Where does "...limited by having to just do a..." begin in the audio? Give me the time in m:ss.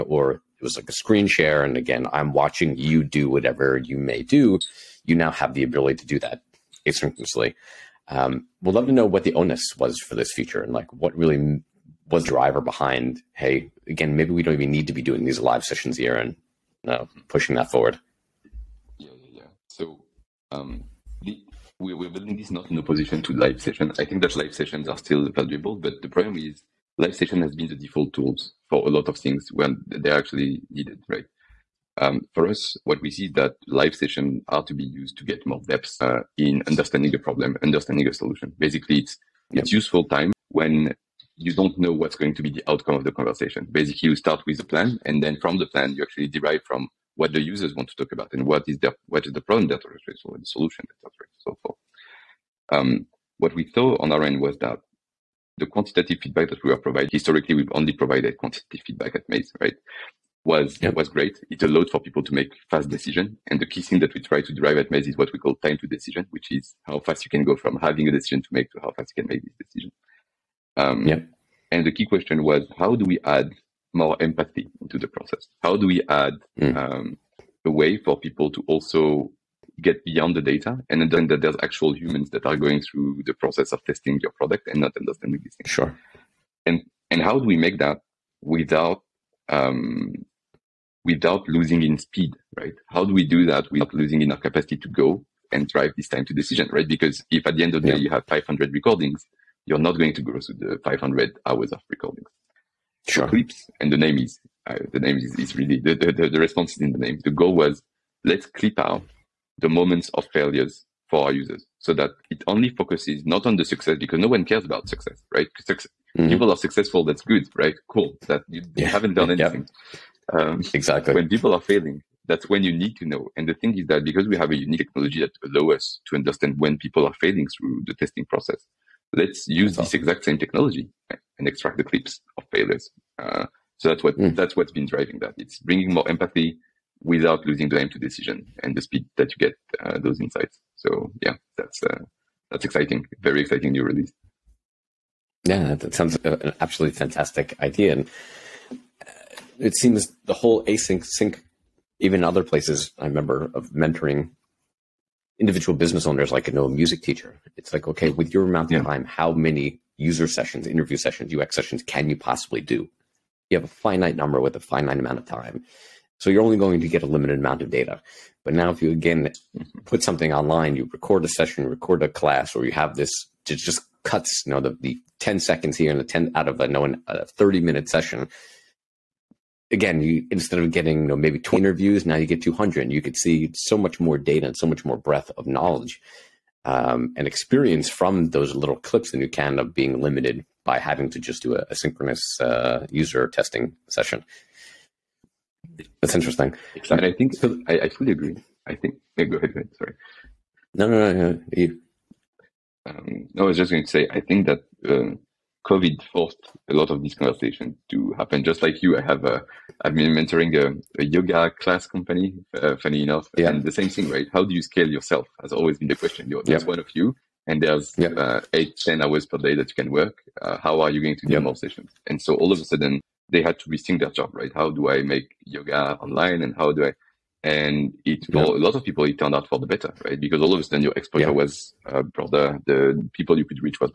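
3:10.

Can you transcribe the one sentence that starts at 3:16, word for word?
And I think so, I, I fully agree.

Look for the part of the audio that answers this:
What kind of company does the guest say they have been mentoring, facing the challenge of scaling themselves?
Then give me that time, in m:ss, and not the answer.
3:31.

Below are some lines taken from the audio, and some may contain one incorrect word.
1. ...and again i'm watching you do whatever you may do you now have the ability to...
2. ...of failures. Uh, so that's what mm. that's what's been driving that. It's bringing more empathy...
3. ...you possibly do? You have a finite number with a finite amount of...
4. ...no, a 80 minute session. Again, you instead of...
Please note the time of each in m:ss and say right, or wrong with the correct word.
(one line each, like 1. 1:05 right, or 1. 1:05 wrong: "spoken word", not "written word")
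1. 0:01 right
2. 2:12 right
3. 2:42 right
4. 2:56 wrong: "30", not "80".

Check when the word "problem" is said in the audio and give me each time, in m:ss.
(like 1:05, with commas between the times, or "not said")
0:26, 0:37, 0:49.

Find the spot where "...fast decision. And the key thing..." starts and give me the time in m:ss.
1:02.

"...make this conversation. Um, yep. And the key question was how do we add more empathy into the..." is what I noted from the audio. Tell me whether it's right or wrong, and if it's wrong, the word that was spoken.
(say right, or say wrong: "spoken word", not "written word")
wrong: "decision", not "conversation".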